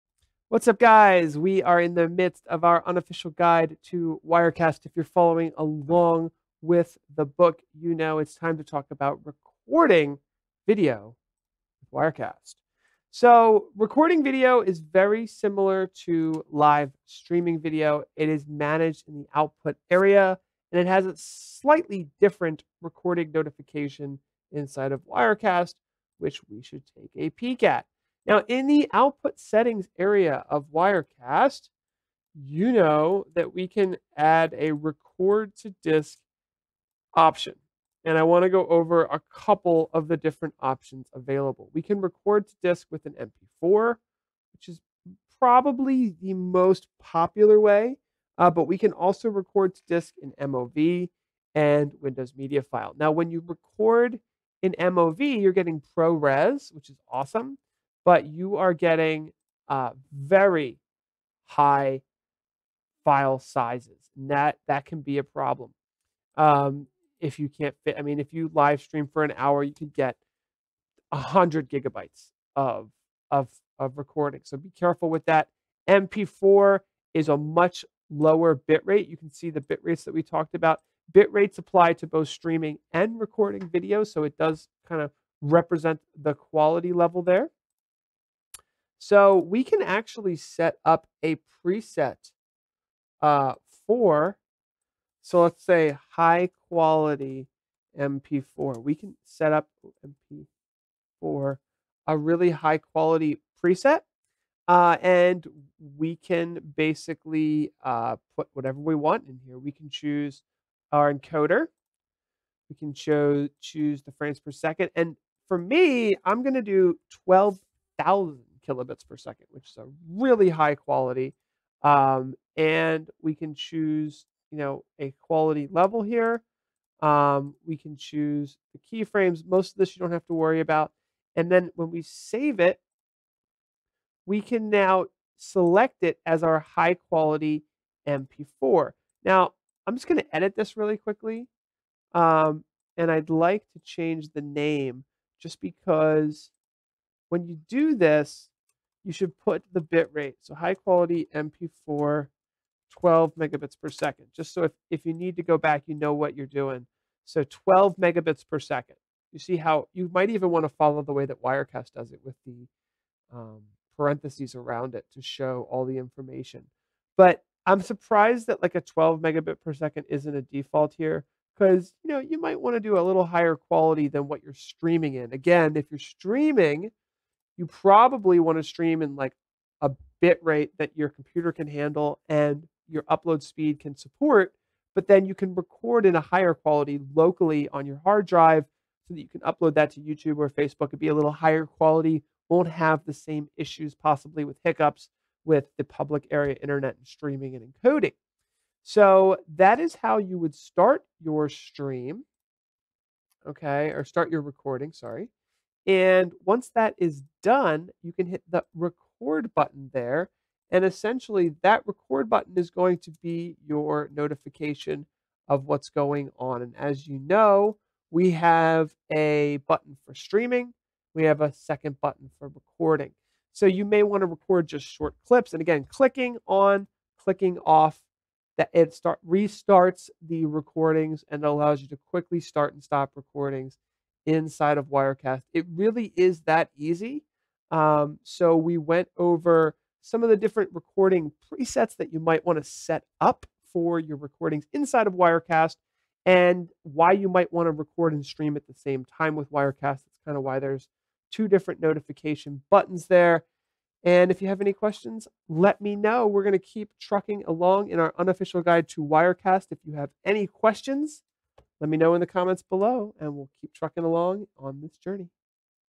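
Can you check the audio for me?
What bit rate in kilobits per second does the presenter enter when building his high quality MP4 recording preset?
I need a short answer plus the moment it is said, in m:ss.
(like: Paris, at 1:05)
12,000, at 1:57.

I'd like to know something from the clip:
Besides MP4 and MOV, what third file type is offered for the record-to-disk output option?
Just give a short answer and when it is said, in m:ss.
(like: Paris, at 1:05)
Windows Media File, at 0:52.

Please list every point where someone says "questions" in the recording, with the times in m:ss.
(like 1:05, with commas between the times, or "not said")
4:14, 4:20.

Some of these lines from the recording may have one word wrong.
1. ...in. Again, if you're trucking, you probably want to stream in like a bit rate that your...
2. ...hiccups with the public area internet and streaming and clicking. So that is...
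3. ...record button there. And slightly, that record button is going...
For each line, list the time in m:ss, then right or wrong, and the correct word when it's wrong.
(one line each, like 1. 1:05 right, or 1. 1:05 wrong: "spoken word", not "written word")
1. 2:55 wrong: "streaming", not "trucking"
2. 3:14 wrong: "encoding", not "clicking"
3. 3:28 wrong: "essentially", not "slightly".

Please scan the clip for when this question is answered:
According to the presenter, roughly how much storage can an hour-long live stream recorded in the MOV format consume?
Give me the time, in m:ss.
1:11.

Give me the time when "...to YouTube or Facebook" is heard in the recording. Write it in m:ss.
3:09.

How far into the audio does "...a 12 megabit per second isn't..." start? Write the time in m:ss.
2:48.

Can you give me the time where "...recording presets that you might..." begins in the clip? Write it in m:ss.
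4:00.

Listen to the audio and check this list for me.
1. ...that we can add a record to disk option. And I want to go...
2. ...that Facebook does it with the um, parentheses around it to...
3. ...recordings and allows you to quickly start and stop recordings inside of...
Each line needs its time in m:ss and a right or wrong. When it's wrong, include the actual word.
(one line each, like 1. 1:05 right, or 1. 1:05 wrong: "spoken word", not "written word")
1. 0:33 right
2. 2:41 wrong: "Wirecast", not "Facebook"
3. 3:50 right.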